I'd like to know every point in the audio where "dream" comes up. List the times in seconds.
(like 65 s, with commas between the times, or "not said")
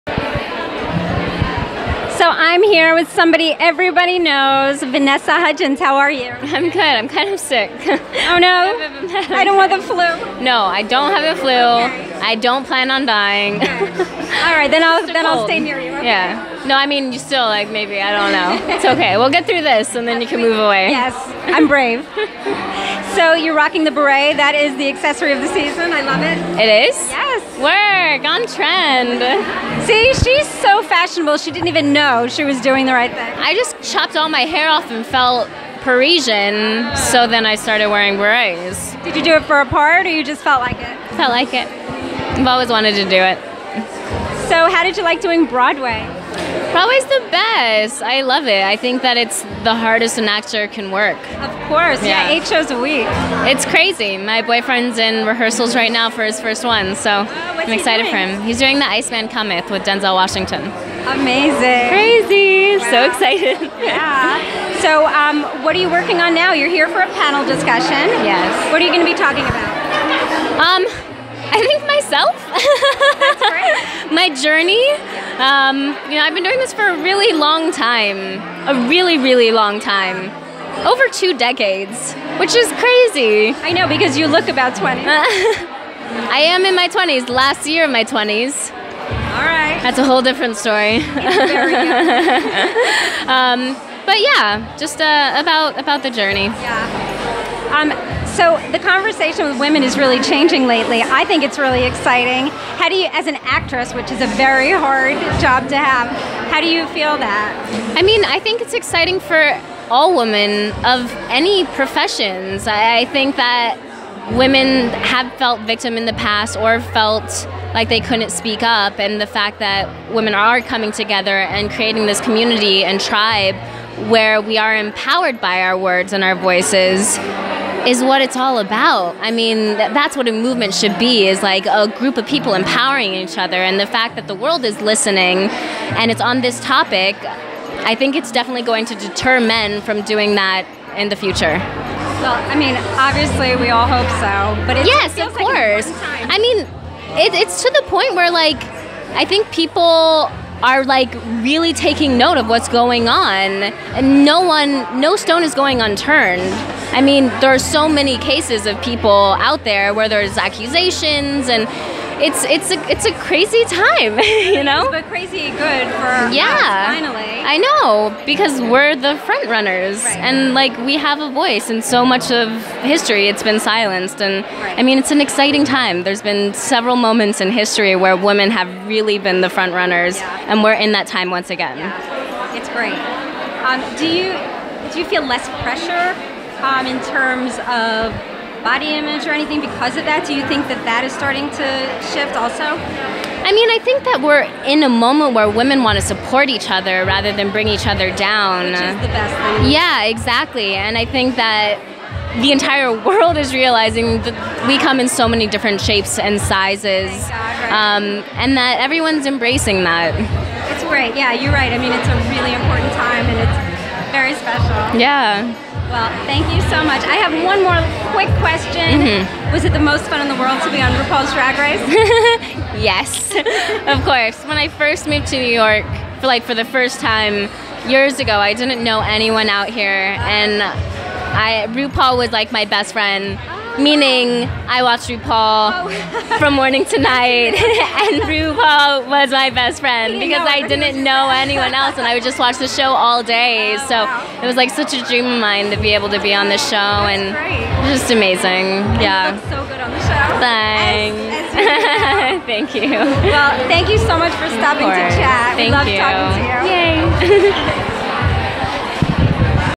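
245 s.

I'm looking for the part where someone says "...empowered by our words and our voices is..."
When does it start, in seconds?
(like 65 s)
124 s.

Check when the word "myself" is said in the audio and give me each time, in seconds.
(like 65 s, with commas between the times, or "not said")
71 s.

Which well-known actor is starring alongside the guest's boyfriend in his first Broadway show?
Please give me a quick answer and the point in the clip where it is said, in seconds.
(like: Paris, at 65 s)
Denzel Washington, at 59 s.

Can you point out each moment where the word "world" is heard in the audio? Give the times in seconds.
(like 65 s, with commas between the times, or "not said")
134 s, 203 s, 220 s.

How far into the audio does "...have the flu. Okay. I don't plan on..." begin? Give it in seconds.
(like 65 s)
11 s.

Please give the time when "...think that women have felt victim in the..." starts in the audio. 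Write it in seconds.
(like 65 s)
113 s.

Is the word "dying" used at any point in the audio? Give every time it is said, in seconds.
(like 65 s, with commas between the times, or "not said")
13 s.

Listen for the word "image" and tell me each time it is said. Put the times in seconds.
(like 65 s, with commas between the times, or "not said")
188 s.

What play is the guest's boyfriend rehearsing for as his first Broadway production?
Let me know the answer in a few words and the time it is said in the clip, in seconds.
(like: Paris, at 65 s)
The Iceman Cometh, at 58 s.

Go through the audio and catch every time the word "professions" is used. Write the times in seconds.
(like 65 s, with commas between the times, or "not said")
111 s.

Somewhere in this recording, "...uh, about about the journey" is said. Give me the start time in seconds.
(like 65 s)
94 s.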